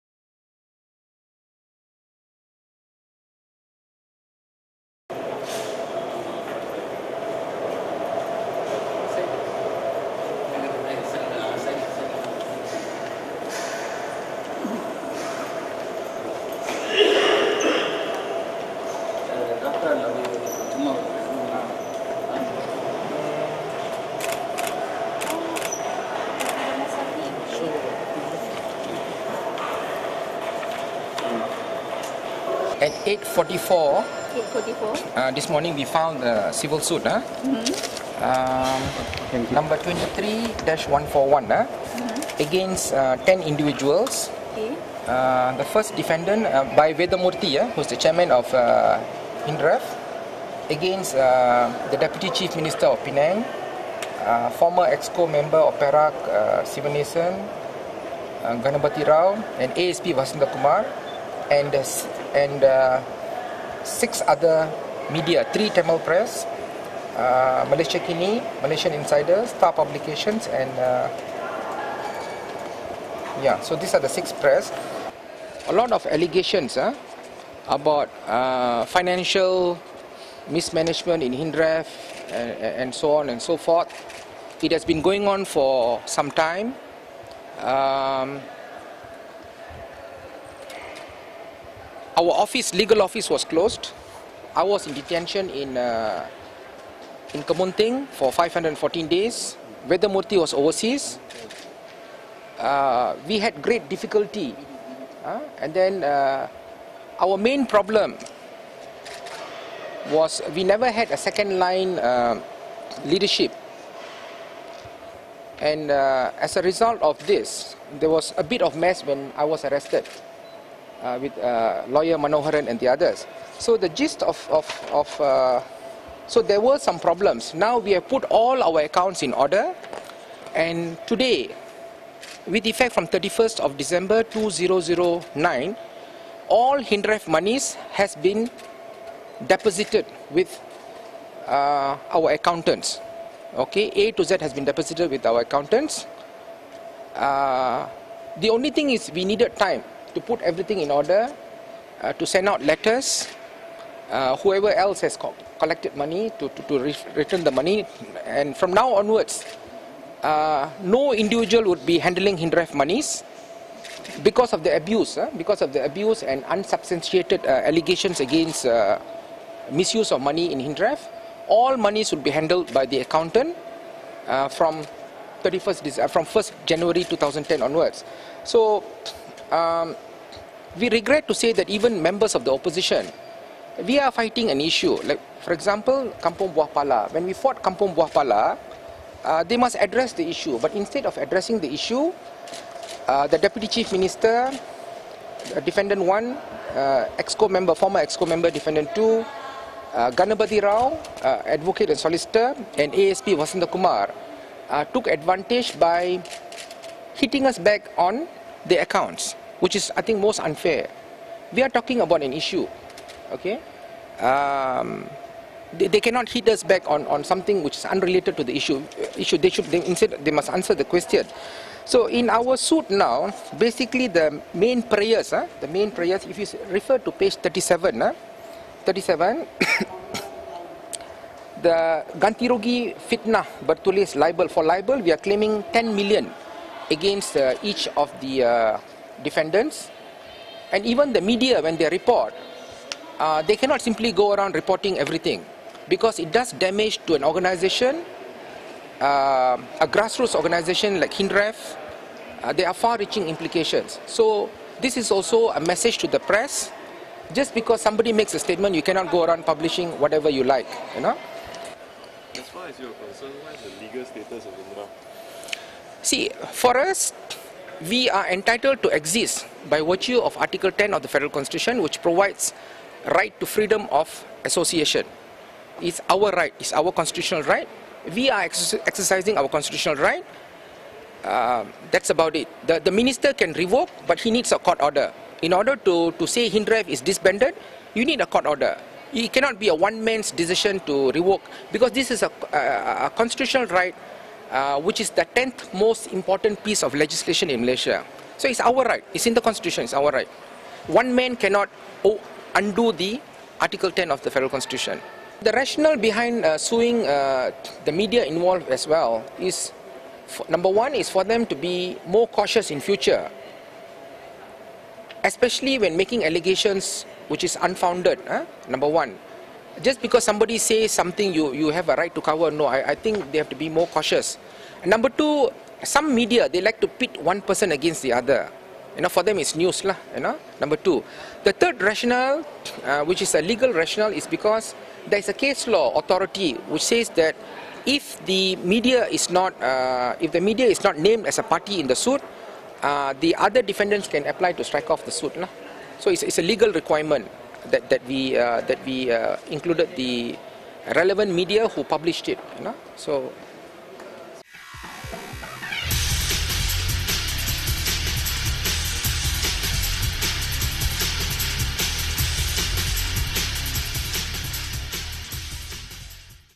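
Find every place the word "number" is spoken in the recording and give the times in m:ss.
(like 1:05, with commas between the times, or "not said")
0:39, 5:10, 5:18, 5:24, 5:30.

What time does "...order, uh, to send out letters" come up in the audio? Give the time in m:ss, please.
2:30.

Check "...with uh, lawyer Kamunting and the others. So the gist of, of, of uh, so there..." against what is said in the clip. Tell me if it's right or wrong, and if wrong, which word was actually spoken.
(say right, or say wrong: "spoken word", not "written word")
wrong: "Manoharan", not "Kamunting".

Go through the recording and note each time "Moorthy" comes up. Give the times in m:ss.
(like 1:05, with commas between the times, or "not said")
0:47, 1:40.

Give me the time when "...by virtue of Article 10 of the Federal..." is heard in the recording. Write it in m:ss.
4:29.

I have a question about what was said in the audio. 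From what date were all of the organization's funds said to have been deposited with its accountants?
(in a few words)
31 December 2009.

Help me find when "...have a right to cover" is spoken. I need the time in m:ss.
5:21.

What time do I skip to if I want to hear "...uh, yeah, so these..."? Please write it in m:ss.
1:10.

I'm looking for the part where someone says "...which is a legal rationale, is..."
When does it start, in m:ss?
5:33.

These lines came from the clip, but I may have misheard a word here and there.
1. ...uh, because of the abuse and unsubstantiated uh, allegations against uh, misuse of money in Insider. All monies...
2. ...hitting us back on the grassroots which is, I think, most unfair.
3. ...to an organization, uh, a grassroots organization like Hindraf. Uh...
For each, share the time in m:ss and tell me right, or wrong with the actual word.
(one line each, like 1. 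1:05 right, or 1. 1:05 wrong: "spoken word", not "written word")
1. 2:45 wrong: "Hindraf", not "Insider"
2. 3:27 wrong: "accounts", not "grassroots"
3. 4:07 right.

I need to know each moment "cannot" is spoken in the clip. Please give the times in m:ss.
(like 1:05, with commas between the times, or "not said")
3:36, 4:03, 4:18, 4:49, 5:01.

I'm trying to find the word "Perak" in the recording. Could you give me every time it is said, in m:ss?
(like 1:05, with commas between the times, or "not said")
0:55.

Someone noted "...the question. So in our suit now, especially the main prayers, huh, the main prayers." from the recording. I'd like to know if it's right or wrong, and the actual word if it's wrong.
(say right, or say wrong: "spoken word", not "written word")
wrong: "basically", not "especially".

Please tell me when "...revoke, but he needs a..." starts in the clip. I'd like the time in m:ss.
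4:43.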